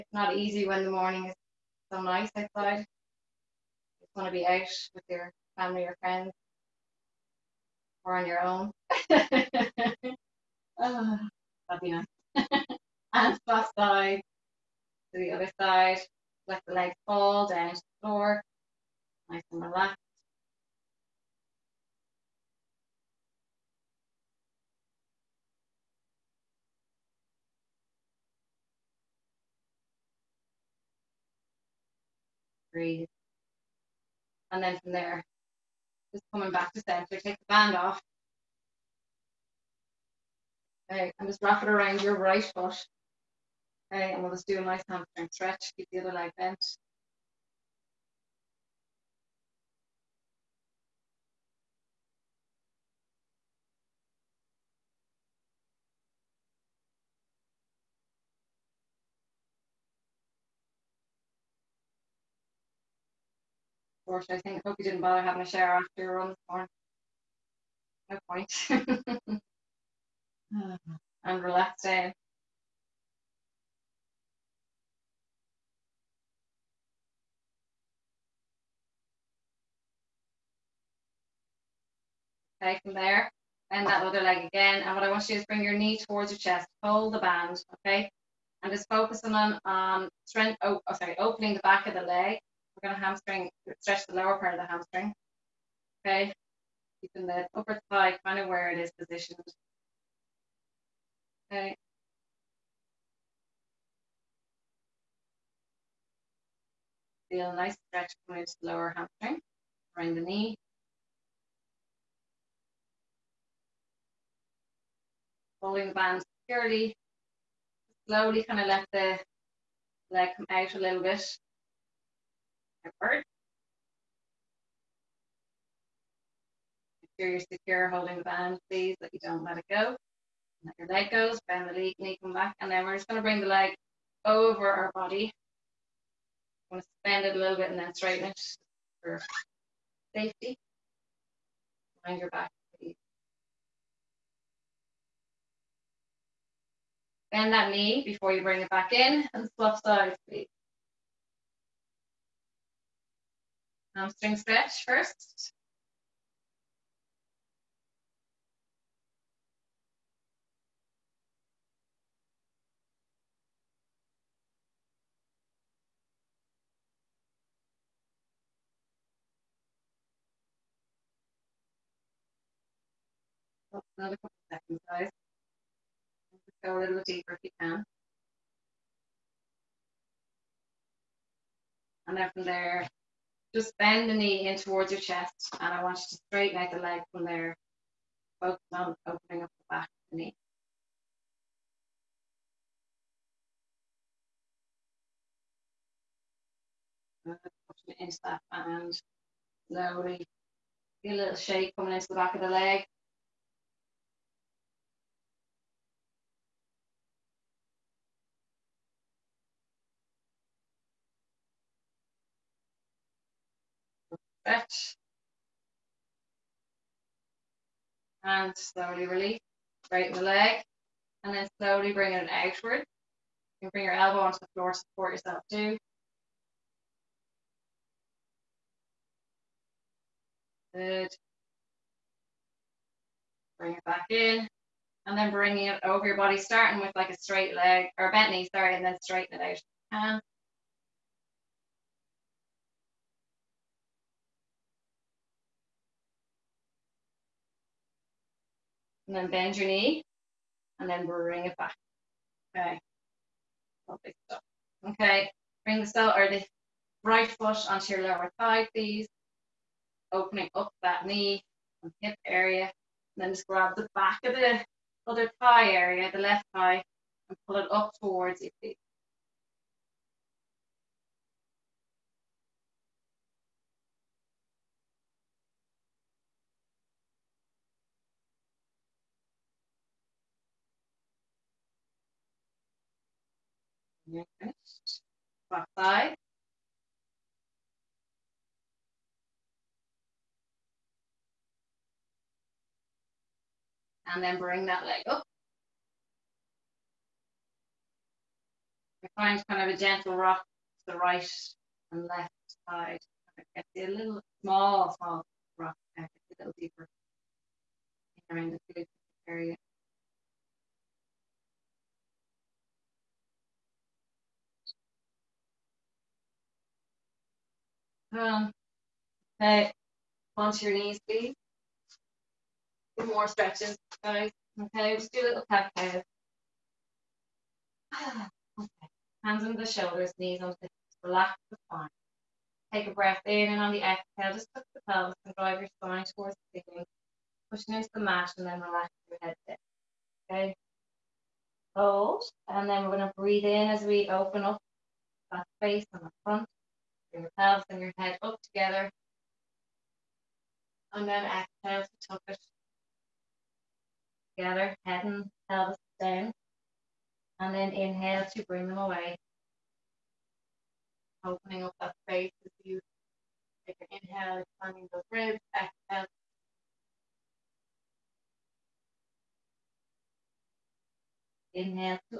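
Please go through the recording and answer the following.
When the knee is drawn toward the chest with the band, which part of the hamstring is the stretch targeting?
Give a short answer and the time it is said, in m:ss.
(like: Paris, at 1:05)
lower part, at 1:34.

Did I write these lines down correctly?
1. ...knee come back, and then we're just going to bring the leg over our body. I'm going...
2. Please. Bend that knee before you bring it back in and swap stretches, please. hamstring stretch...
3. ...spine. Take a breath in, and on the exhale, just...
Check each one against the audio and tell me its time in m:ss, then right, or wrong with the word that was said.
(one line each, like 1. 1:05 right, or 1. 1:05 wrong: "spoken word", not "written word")
1. 2:11 right
2. 2:22 wrong: "sides", not "stretches"
3. 5:31 right.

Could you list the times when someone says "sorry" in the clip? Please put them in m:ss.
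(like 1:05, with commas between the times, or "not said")
1:30, 3:58.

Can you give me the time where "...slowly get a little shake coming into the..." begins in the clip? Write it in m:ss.
3:19.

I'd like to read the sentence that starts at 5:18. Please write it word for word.
okay, um, onto your knees, please.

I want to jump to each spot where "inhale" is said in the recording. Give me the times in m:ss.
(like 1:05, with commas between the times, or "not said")
5:57, 6:04, 6:11.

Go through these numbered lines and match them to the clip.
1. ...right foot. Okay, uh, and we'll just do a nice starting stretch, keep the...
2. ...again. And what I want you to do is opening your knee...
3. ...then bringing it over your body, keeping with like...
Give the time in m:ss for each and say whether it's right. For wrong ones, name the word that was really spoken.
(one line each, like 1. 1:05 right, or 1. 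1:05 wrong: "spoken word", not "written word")
1. 0:42 wrong: "hamstring", not "starting"
2. 1:24 wrong: "bring", not "opening"
3. 3:55 wrong: "starting", not "keeping".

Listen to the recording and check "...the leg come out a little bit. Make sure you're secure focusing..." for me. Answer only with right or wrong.
wrong.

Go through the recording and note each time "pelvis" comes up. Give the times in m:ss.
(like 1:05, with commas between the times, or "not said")
5:34, 5:47, 5:55.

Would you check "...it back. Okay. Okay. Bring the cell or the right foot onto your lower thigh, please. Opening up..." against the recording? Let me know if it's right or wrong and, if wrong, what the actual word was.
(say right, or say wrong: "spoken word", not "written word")
right.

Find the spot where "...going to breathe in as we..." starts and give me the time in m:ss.
5:42.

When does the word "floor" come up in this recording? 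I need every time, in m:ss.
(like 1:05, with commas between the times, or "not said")
0:18, 3:44.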